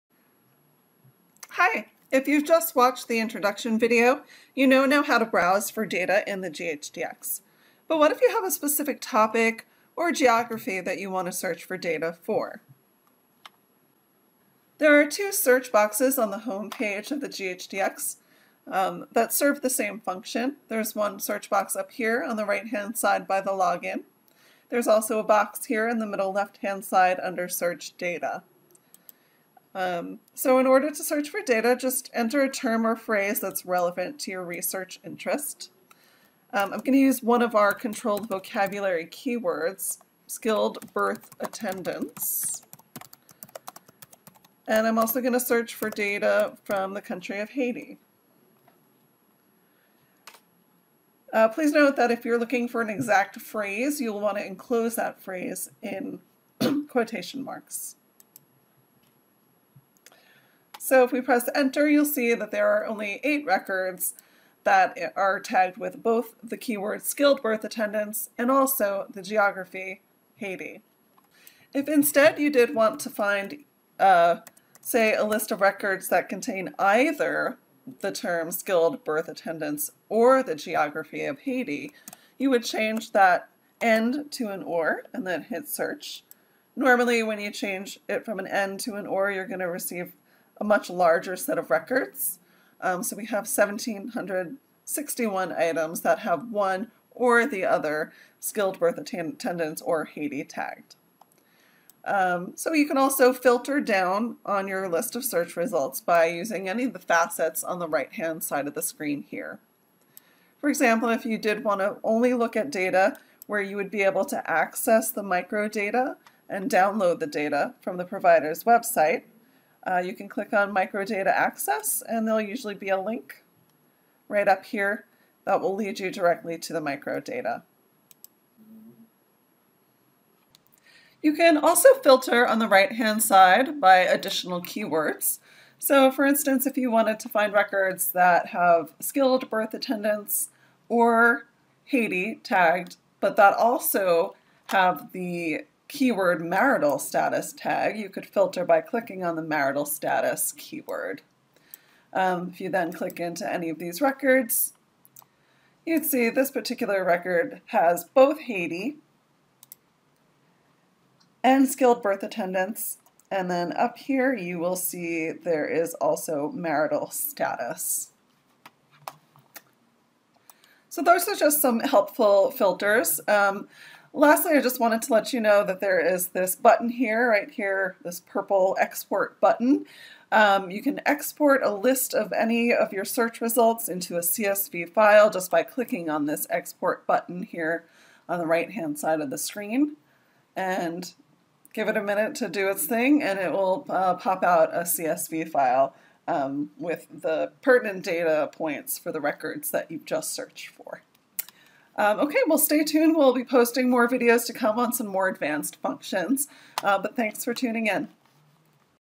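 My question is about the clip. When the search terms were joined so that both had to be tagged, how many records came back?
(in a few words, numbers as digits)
8.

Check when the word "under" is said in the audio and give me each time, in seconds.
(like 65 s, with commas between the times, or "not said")
27 s.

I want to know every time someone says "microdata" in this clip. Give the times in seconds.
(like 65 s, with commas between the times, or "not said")
115 s, 120 s, 126 s.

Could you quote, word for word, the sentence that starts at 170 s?
So those are just some helpful filters.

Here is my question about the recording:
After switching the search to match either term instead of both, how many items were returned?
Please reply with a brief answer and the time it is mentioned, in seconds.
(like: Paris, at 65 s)
1,761, at 93 s.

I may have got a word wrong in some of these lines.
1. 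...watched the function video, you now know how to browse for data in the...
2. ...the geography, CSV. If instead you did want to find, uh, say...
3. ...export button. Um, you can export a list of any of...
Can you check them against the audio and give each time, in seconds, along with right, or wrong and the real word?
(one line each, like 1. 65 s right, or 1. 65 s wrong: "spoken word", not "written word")
1. 2 s wrong: "introduction", not "function"
2. 69 s wrong: "Haiti", not "CSV"
3. 178 s right.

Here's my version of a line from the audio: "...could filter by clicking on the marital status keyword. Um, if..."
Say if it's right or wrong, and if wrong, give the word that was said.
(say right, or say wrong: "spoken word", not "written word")
right.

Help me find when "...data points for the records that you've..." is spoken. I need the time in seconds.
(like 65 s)
198 s.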